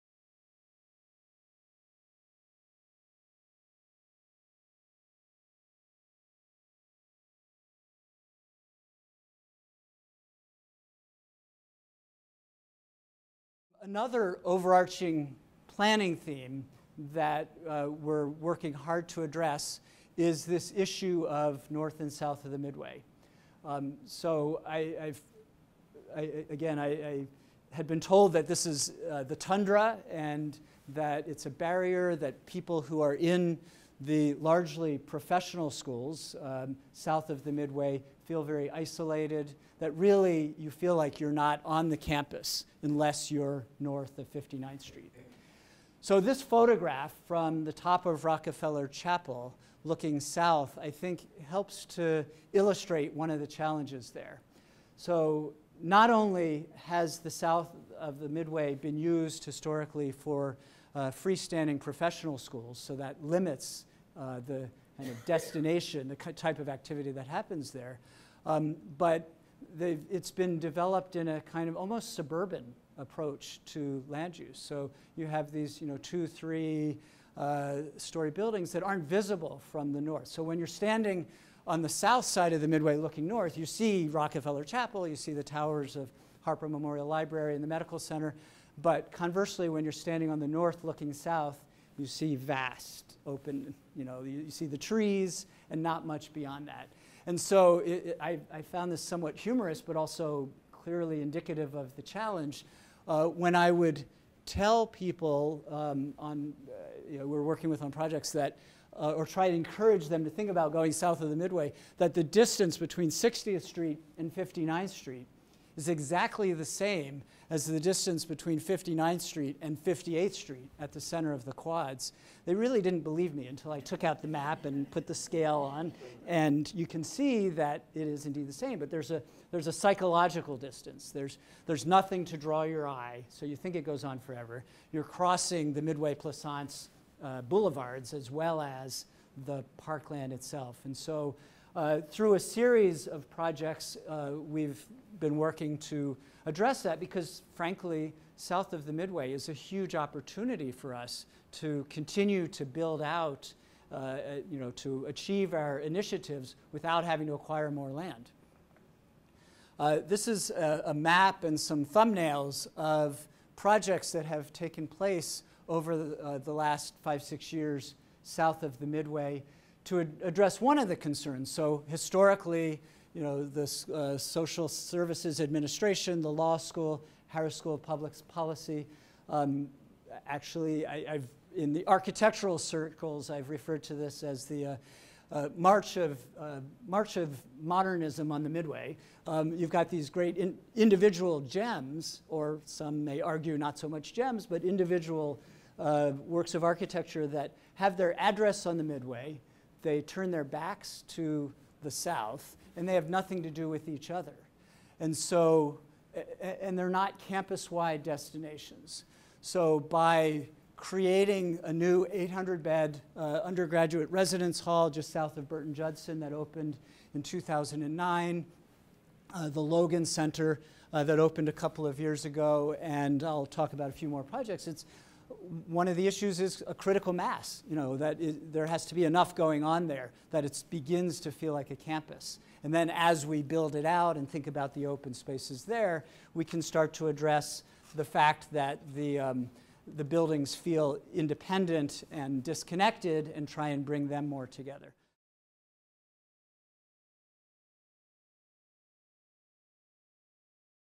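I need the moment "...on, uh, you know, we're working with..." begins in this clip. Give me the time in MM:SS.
01:46.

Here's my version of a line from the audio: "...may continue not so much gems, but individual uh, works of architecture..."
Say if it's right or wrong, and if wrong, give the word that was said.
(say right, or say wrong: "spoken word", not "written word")
wrong: "argue", not "continue".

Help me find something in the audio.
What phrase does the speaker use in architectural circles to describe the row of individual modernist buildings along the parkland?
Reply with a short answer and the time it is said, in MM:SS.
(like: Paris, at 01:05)
march of modernism, at 03:06.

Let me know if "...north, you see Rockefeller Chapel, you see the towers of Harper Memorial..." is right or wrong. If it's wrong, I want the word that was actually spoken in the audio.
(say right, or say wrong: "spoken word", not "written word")
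right.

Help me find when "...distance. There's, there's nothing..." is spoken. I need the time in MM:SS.
02:10.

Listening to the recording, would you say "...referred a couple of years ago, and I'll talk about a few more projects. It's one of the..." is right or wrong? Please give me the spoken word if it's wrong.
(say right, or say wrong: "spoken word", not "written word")
wrong: "opened", not "referred".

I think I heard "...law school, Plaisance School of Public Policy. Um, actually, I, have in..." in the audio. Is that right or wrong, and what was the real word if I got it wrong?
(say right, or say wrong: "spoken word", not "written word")
wrong: "Harris", not "Plaisance".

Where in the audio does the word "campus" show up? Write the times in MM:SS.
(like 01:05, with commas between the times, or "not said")
00:41, 03:27, 03:51.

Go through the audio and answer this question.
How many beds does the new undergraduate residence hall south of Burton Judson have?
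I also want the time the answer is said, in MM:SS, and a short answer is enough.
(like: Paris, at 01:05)
800, at 03:32.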